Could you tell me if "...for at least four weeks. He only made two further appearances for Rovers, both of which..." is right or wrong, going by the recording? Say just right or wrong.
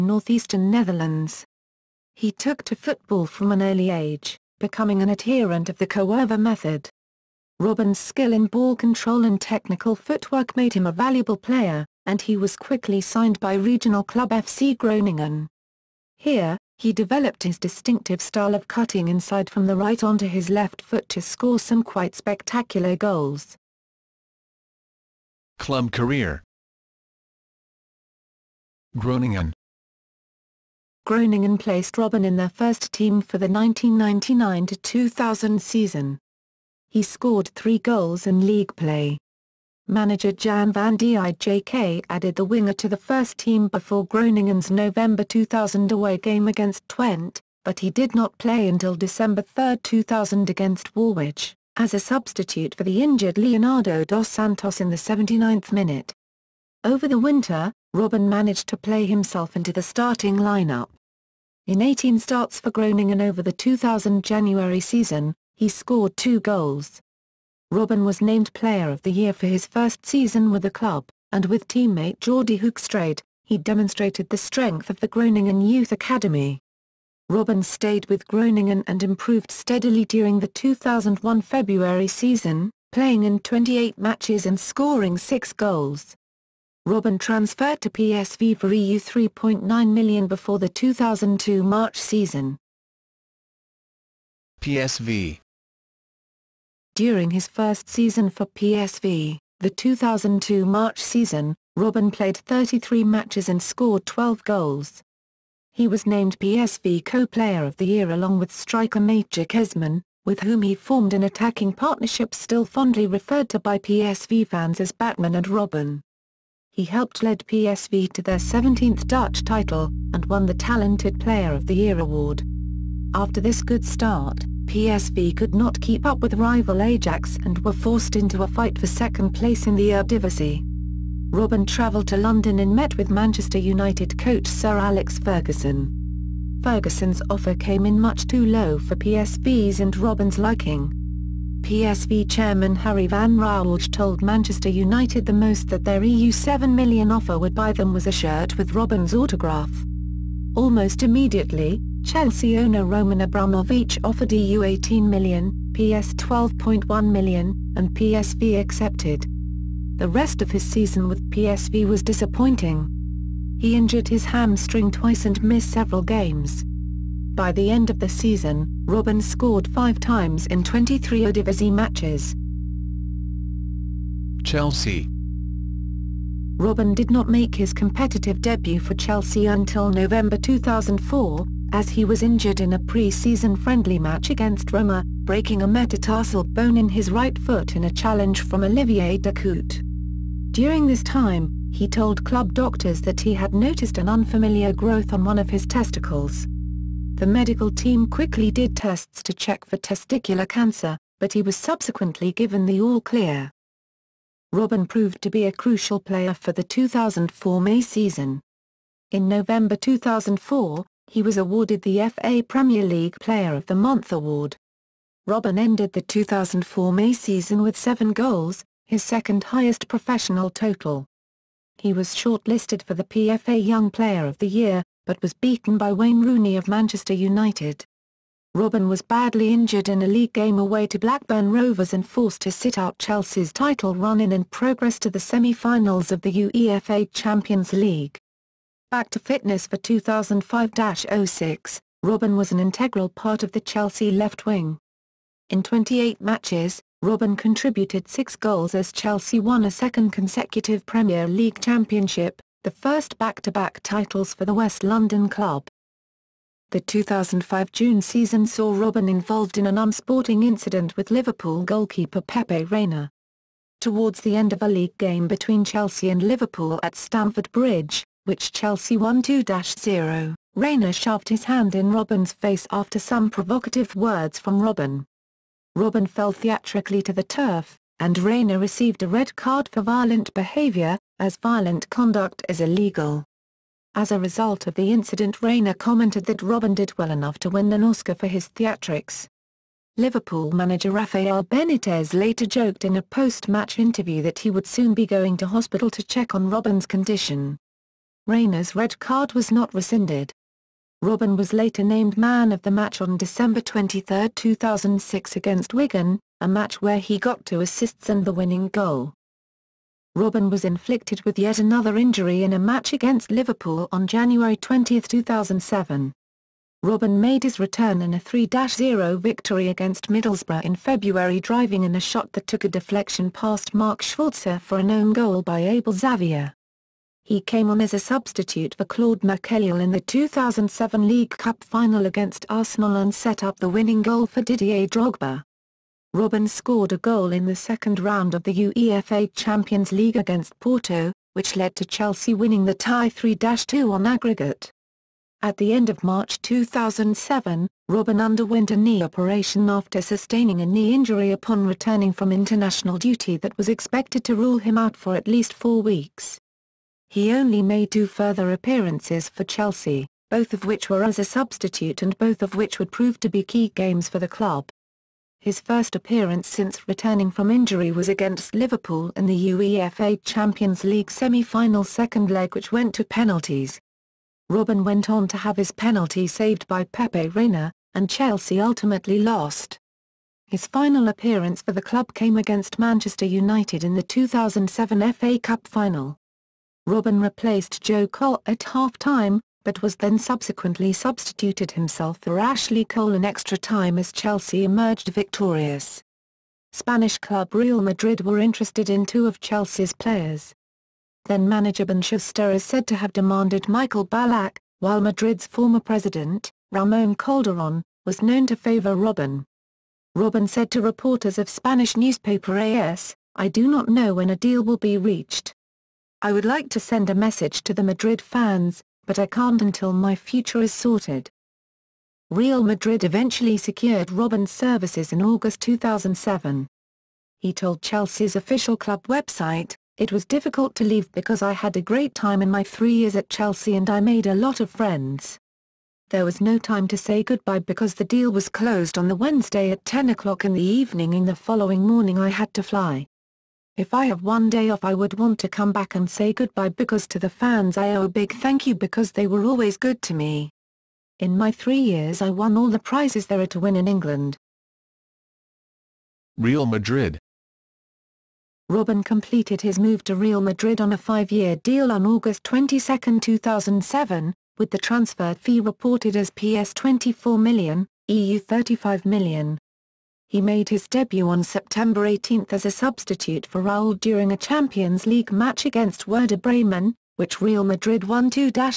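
wrong.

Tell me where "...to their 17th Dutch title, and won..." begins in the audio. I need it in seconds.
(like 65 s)
118 s.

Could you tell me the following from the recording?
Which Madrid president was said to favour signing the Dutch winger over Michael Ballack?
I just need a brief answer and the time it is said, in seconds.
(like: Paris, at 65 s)
Ramon Calderon, at 406 s.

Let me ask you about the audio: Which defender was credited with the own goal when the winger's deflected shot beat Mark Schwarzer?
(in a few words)
Abel Xavier.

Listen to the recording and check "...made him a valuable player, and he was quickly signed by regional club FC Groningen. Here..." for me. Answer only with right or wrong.
right.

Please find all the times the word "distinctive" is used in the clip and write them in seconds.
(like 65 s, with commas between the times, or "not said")
17 s.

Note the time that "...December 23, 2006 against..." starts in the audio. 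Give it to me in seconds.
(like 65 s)
303 s.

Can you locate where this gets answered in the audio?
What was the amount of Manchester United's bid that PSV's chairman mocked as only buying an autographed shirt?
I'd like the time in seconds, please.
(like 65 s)
146 s.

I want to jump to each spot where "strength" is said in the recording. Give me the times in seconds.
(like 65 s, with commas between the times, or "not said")
74 s.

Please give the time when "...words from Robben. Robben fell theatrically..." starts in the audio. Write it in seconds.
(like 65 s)
273 s.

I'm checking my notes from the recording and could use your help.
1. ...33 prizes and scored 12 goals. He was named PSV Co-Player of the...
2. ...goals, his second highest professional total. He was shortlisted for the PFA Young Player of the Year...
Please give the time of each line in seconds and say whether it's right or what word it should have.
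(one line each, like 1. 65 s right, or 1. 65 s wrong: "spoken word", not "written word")
1. 102 s wrong: "matches", not "prizes"
2. 218 s right.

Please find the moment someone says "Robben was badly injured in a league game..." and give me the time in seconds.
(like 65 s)
228 s.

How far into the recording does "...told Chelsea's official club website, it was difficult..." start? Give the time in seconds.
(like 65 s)
427 s.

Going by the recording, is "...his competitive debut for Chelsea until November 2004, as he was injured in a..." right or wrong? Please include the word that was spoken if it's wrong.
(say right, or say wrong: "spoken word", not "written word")
right.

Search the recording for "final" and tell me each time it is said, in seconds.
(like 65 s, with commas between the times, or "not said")
235 s, 331 s, 371 s, 380 s, 385 s.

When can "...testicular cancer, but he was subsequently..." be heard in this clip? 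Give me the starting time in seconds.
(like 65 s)
199 s.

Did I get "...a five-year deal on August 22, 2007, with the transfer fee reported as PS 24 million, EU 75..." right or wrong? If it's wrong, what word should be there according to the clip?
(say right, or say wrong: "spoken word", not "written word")
wrong: "35", not "75".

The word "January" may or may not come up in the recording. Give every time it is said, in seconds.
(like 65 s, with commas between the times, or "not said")
64 s, 314 s.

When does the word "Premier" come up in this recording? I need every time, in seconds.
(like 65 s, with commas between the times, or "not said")
212 s, 250 s.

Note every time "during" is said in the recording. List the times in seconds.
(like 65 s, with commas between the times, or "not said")
80 s, 96 s, 190 s, 473 s.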